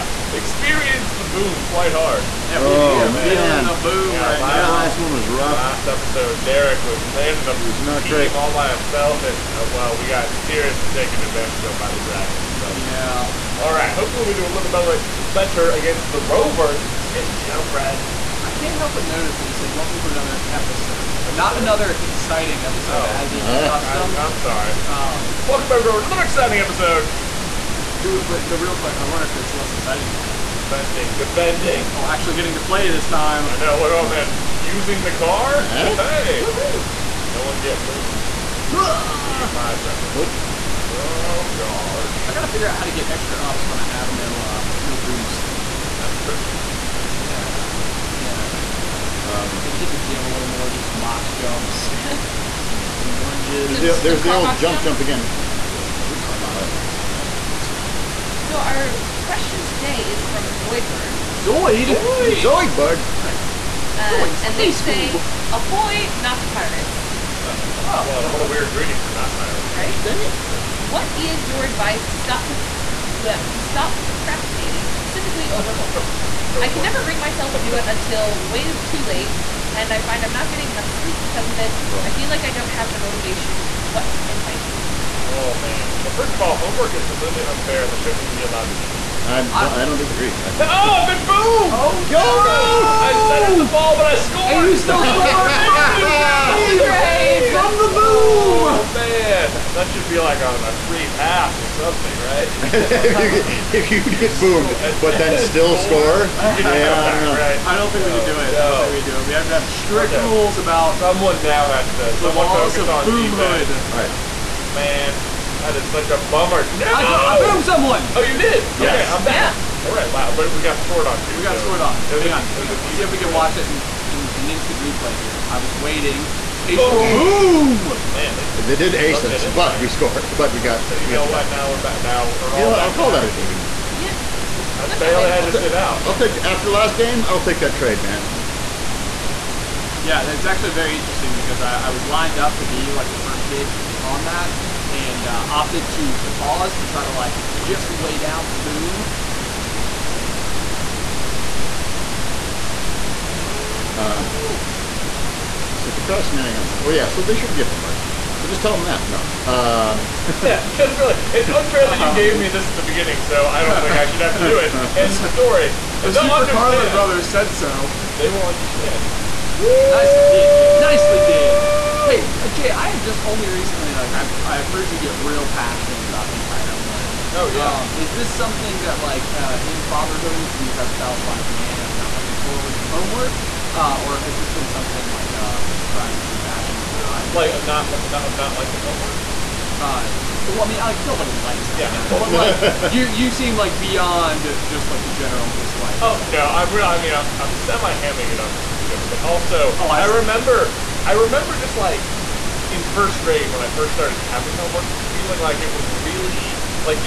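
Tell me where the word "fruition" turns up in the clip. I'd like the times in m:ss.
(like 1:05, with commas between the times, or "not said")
not said.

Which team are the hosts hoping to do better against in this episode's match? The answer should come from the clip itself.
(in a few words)
Rovers.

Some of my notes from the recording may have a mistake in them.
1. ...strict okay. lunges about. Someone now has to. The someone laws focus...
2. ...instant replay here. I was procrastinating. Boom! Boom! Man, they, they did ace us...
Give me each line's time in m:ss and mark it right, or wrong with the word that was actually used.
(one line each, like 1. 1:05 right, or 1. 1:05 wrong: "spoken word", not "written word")
1. 1:49 wrong: "rules", not "lunges"
2. 2:04 wrong: "waiting", not "procrastinating".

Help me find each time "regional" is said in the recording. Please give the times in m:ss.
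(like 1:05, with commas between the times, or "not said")
not said.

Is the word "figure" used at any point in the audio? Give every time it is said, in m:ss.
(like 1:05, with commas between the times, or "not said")
0:42.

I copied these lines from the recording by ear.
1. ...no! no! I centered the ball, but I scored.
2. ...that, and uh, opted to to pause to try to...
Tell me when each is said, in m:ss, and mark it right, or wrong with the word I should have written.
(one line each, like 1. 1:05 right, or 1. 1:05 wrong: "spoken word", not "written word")
1. 1:32 right
2. 2:24 right.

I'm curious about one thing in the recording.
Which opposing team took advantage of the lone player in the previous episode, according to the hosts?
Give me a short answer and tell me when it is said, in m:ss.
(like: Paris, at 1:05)
Dragons, at 0:11.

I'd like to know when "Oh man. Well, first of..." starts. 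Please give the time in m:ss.
1:25.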